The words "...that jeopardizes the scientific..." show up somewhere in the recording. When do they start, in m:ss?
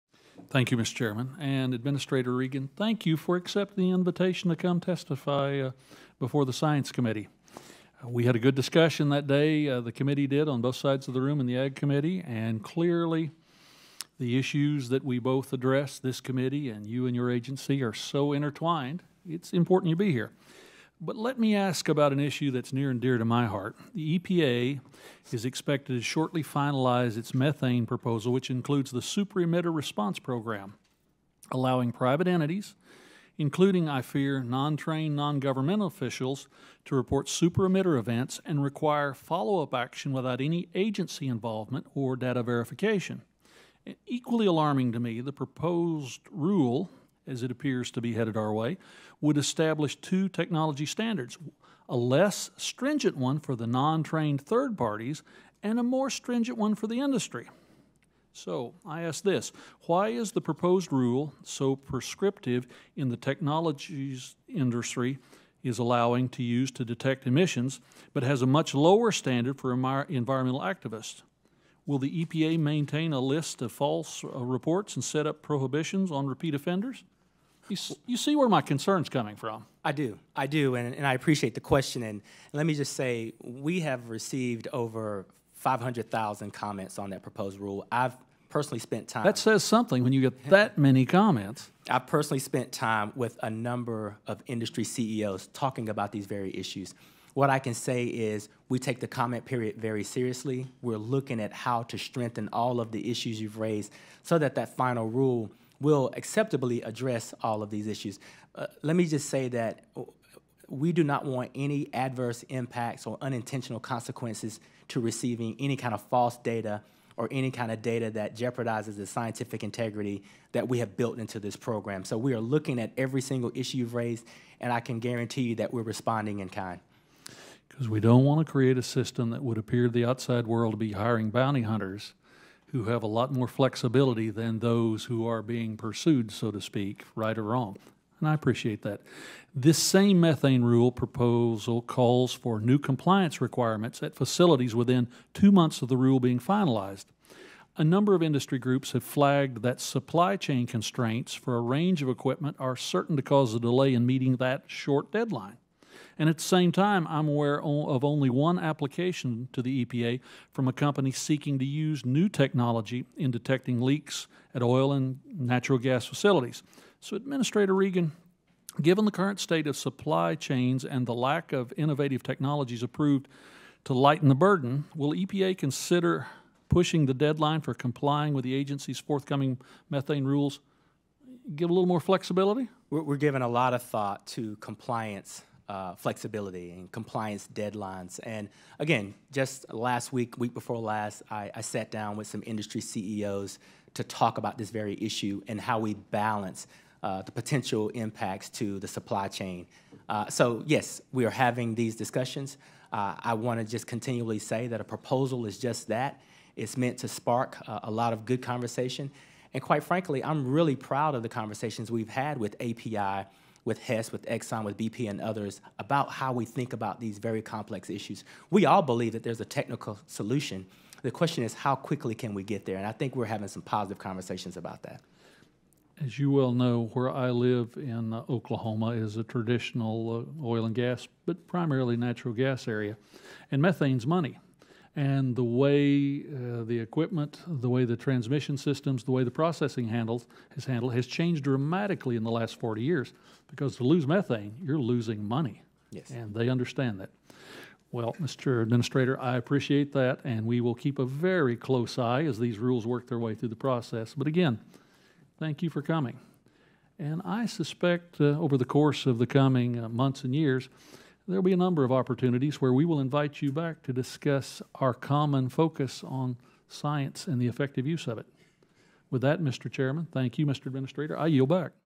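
1:58.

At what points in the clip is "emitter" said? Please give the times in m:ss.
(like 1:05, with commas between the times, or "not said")
0:29, 0:37.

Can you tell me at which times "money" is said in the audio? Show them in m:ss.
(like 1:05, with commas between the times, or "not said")
3:54, 4:05.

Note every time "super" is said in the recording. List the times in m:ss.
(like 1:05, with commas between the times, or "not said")
0:29, 0:37.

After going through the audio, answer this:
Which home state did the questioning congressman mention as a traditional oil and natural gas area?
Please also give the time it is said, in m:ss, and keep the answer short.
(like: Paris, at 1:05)
Oklahoma, at 3:48.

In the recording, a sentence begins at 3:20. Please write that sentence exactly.
Uh, so yes, we are having these discussions.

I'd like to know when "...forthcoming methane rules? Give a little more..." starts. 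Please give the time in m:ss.
2:58.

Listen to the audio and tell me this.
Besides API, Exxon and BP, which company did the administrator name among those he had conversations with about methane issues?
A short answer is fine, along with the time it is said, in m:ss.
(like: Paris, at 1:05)
Hess, at 3:33.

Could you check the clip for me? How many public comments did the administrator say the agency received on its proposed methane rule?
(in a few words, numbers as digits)
Over 500,000.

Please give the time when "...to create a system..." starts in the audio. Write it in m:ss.
2:08.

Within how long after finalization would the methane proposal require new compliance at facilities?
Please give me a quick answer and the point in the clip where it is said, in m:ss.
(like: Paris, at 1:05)
Two months, at 2:25.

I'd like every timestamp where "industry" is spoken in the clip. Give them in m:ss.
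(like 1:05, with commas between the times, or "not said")
0:56, 1:04, 1:34, 2:28, 3:12.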